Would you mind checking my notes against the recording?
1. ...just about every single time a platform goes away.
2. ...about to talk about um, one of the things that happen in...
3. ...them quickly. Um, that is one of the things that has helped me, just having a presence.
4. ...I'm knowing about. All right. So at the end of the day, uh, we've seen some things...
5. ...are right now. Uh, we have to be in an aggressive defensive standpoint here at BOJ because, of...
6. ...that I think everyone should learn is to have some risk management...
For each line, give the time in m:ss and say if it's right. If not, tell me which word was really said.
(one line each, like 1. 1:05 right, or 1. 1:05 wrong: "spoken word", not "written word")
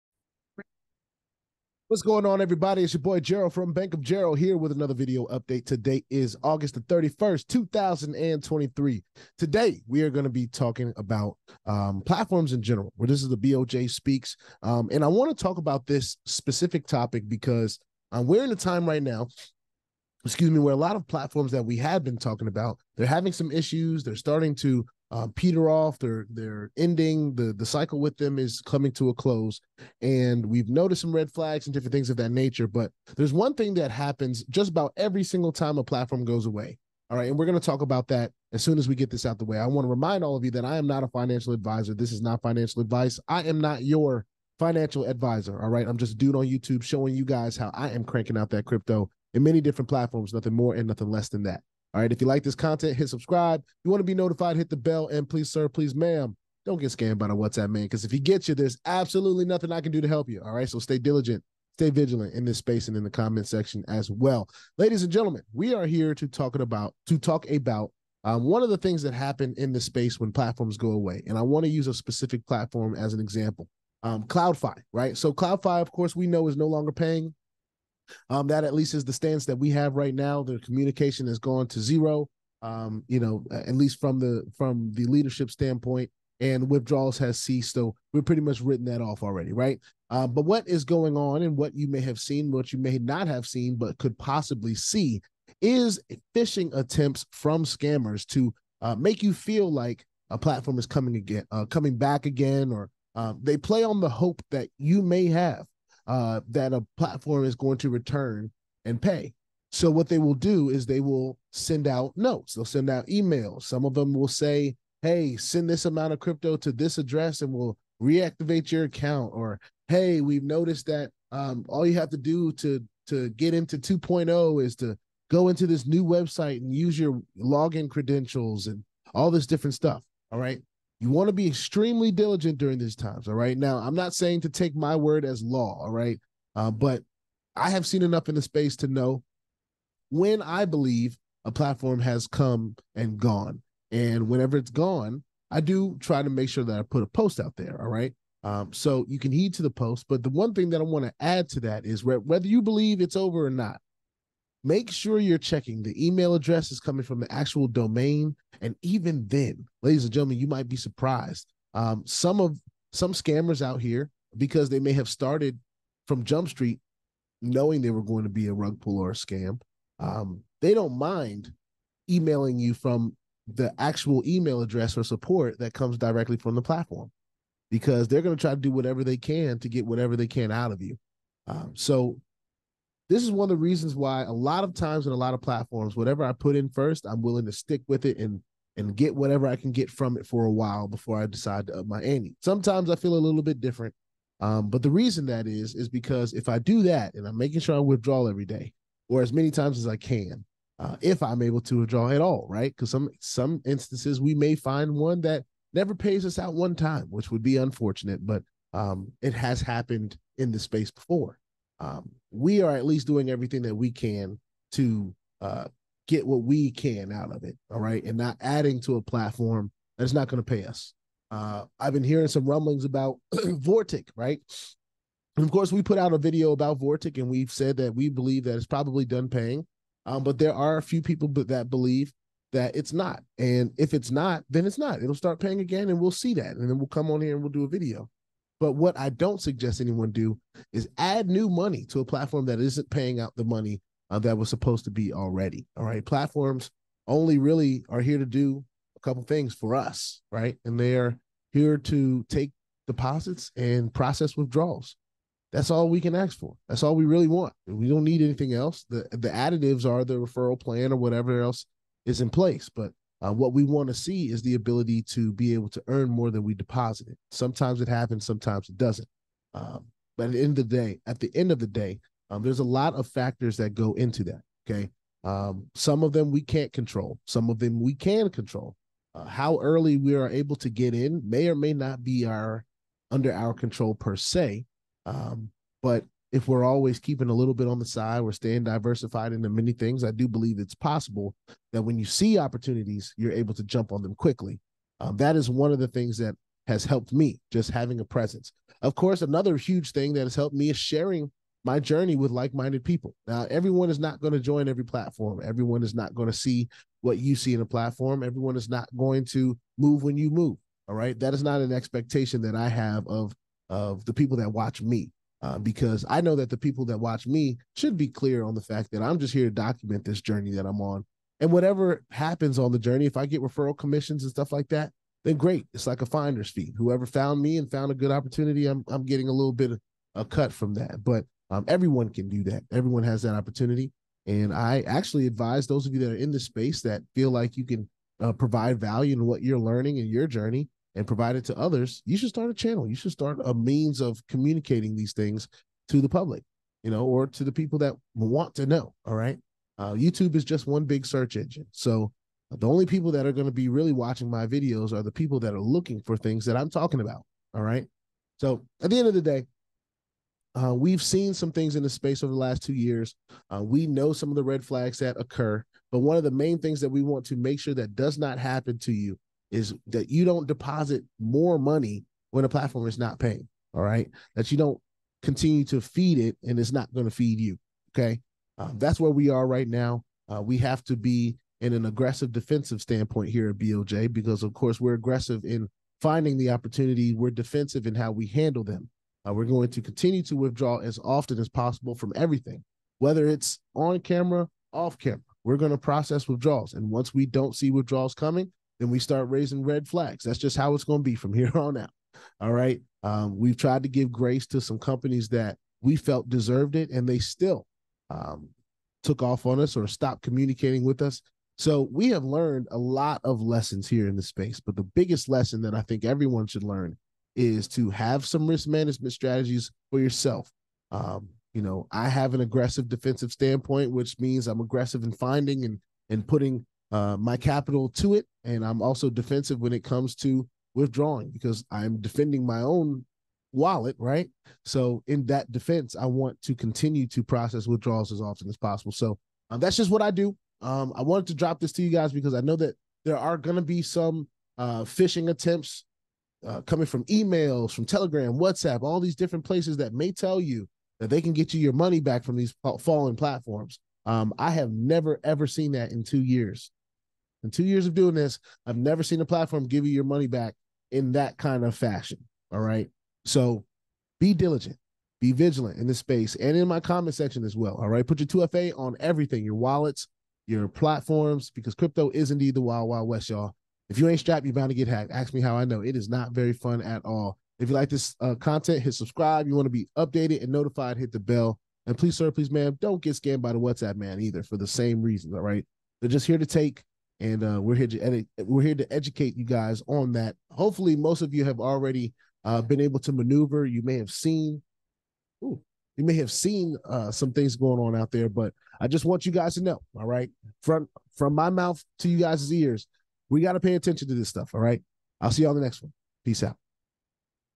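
1. 0:34 right
2. 1:06 right
3. 4:54 right
4. 5:56 wrong: "talking", not "knowing"
5. 6:19 right
6. 6:55 right.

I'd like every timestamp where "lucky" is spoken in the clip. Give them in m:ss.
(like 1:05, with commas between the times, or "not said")
not said.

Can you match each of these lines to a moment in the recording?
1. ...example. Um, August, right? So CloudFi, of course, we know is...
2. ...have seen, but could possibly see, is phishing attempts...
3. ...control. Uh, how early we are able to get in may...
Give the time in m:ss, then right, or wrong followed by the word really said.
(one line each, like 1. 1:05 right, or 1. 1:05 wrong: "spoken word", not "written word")
1. 1:13 wrong: "CloudFi", not "August"
2. 1:33 right
3. 4:38 right.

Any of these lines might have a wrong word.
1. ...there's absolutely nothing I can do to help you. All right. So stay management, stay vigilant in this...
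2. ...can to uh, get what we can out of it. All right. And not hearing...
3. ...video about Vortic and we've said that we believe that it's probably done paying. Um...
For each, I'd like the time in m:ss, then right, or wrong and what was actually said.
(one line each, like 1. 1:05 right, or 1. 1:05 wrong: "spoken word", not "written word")
1. 0:58 wrong: "diligent", not "management"
2. 3:33 wrong: "adding", not "hearing"
3. 3:46 right.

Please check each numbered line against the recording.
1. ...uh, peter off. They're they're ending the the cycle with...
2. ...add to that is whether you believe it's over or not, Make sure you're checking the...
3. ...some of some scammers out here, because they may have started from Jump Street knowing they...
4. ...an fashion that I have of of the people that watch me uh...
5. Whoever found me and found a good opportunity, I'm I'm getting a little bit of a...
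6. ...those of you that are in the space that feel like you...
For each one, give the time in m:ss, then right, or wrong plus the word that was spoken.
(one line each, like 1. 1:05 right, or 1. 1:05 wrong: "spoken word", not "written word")
1. 0:25 right
2. 2:31 right
3. 2:42 right
4. 5:11 wrong: "expectation", not "fashion"
5. 5:26 right
6. 5:35 right.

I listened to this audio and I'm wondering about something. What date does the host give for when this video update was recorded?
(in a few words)
August 31, 2023.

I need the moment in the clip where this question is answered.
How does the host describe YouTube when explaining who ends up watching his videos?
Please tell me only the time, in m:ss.
5:50.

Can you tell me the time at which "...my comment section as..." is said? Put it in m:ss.
7:46.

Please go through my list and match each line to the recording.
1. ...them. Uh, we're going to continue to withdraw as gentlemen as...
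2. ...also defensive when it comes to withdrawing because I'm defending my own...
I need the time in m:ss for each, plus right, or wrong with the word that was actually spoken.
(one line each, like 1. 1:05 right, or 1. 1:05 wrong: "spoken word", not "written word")
1. 6:28 wrong: "often", not "gentlemen"
2. 7:08 right.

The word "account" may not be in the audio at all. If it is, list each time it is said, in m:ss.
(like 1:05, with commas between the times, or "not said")
1:58.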